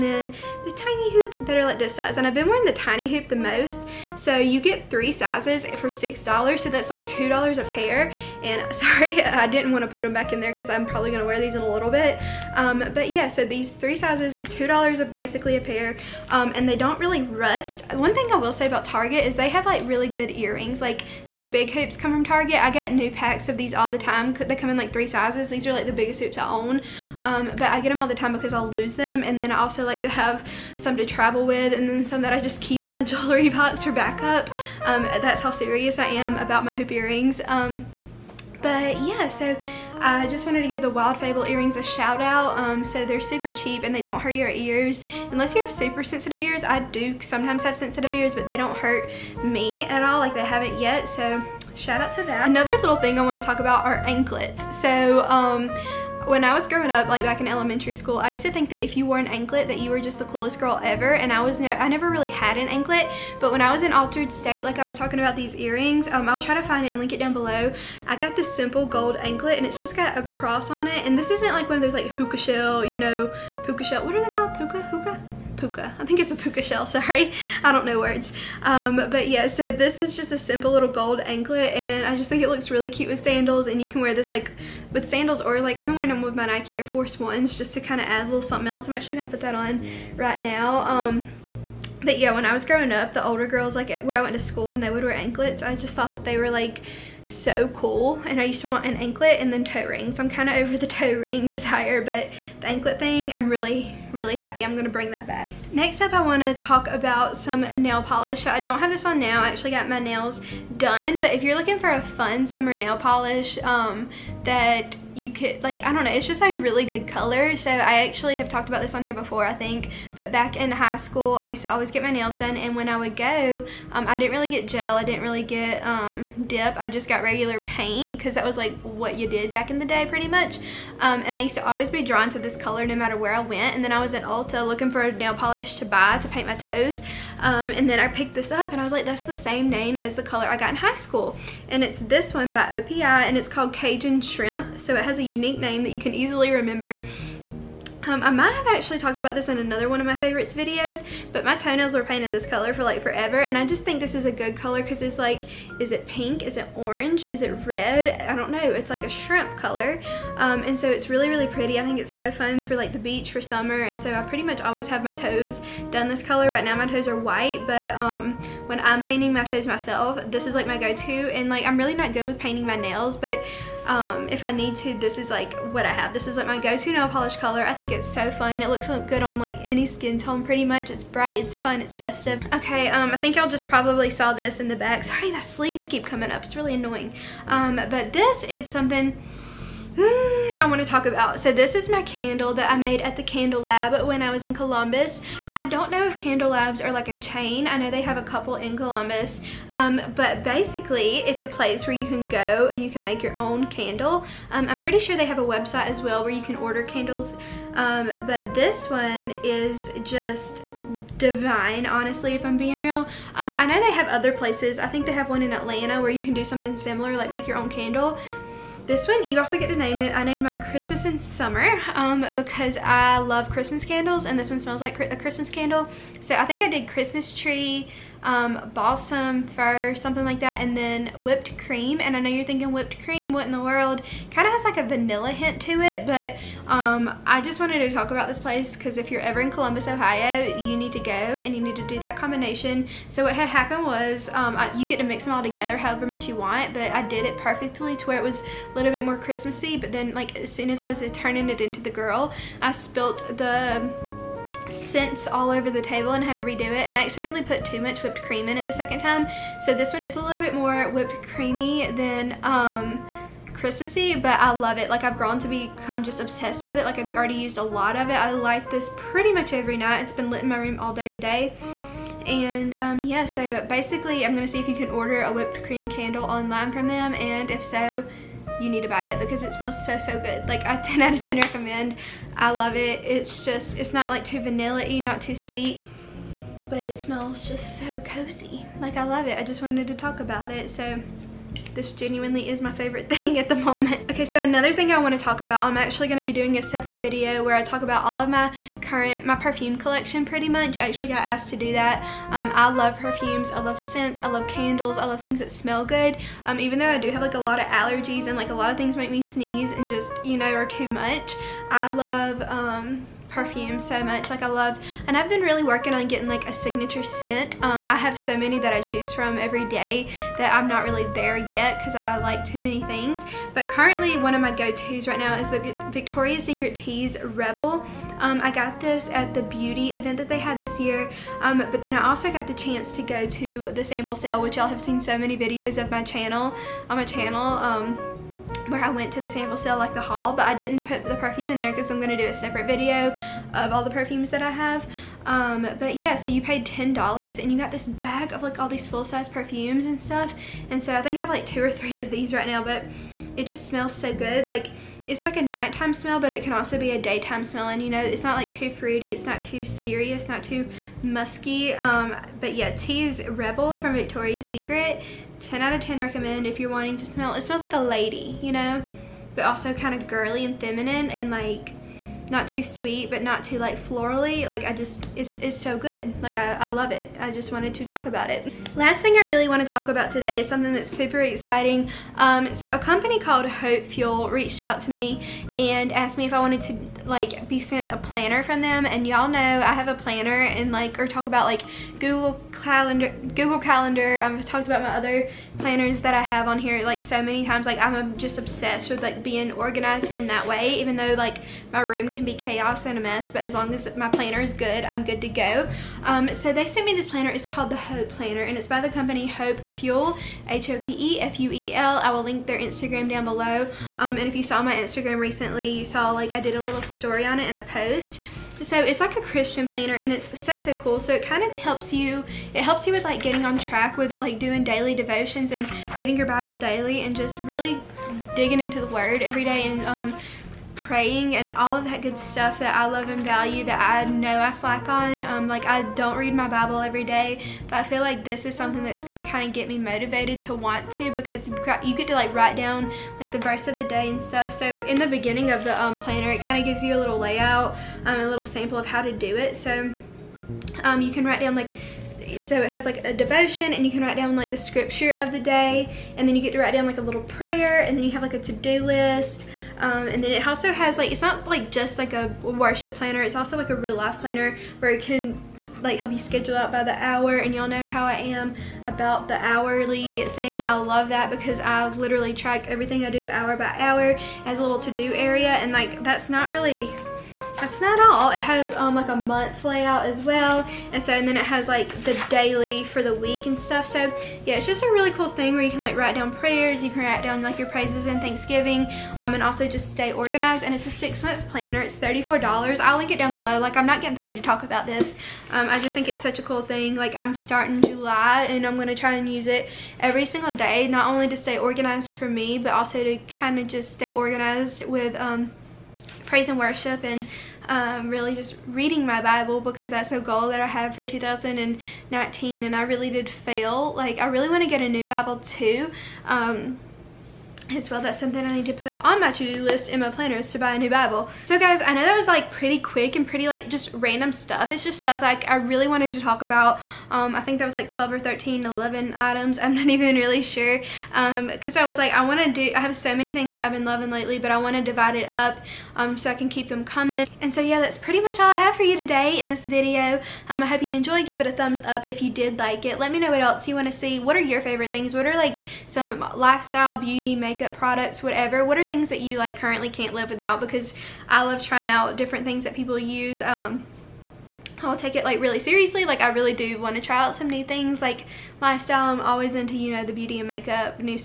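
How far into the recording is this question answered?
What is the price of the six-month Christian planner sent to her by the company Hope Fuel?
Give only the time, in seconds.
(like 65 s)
491 s.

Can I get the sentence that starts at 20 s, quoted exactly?
Like these big hoops come from Target.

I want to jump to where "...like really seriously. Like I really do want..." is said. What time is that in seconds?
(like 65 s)
555 s.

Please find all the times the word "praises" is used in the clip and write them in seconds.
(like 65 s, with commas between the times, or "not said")
487 s, 506 s.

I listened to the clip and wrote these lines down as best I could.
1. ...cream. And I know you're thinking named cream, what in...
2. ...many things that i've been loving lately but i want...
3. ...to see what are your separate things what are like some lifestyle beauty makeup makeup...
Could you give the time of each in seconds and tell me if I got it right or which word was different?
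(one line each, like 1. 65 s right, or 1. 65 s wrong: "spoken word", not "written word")
1. 231 s wrong: "whipped", not "named"
2. 533 s right
3. 543 s wrong: "favorite", not "separate".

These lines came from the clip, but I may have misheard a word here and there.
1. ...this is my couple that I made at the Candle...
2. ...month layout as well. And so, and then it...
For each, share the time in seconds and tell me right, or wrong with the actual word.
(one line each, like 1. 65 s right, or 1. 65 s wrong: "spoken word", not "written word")
1. 191 s wrong: "candle", not "couple"
2. 479 s right.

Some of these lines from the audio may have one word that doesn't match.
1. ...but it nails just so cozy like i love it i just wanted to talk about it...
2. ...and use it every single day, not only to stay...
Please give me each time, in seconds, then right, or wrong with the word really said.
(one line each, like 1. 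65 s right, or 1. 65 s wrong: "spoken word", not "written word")
1. 286 s wrong: "smells", not "nails"
2. 499 s right.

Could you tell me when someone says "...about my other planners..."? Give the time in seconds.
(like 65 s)
394 s.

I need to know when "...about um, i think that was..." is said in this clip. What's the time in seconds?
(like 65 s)
526 s.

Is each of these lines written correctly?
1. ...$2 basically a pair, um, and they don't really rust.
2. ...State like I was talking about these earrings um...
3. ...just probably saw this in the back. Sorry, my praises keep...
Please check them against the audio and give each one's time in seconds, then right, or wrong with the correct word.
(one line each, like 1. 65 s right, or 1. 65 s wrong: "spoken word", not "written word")
1. 14 s right
2. 64 s right
3. 183 s wrong: "sleeves", not "praises".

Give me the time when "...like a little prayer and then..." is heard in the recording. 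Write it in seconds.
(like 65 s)
456 s.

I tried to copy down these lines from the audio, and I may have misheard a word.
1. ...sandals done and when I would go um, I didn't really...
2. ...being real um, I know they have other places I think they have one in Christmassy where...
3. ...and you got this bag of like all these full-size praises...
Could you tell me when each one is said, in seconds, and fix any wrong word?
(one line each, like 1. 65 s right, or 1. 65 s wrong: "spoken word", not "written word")
1. 122 s wrong: "nails", not "sandals"
2. 212 s wrong: "Atlanta", not "Christmassy"
3. 347 s wrong: "perfumes", not "praises".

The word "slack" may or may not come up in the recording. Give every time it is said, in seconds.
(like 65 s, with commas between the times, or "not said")
434 s.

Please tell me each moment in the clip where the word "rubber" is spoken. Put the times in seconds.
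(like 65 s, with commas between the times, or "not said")
not said.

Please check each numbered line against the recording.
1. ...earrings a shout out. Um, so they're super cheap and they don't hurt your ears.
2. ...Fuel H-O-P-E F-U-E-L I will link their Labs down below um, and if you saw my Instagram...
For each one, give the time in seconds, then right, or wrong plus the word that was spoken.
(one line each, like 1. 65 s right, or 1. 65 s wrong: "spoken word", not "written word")
1. 41 s right
2. 409 s wrong: "Instagram", not "Labs".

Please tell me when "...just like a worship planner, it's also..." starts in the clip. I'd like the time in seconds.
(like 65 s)
461 s.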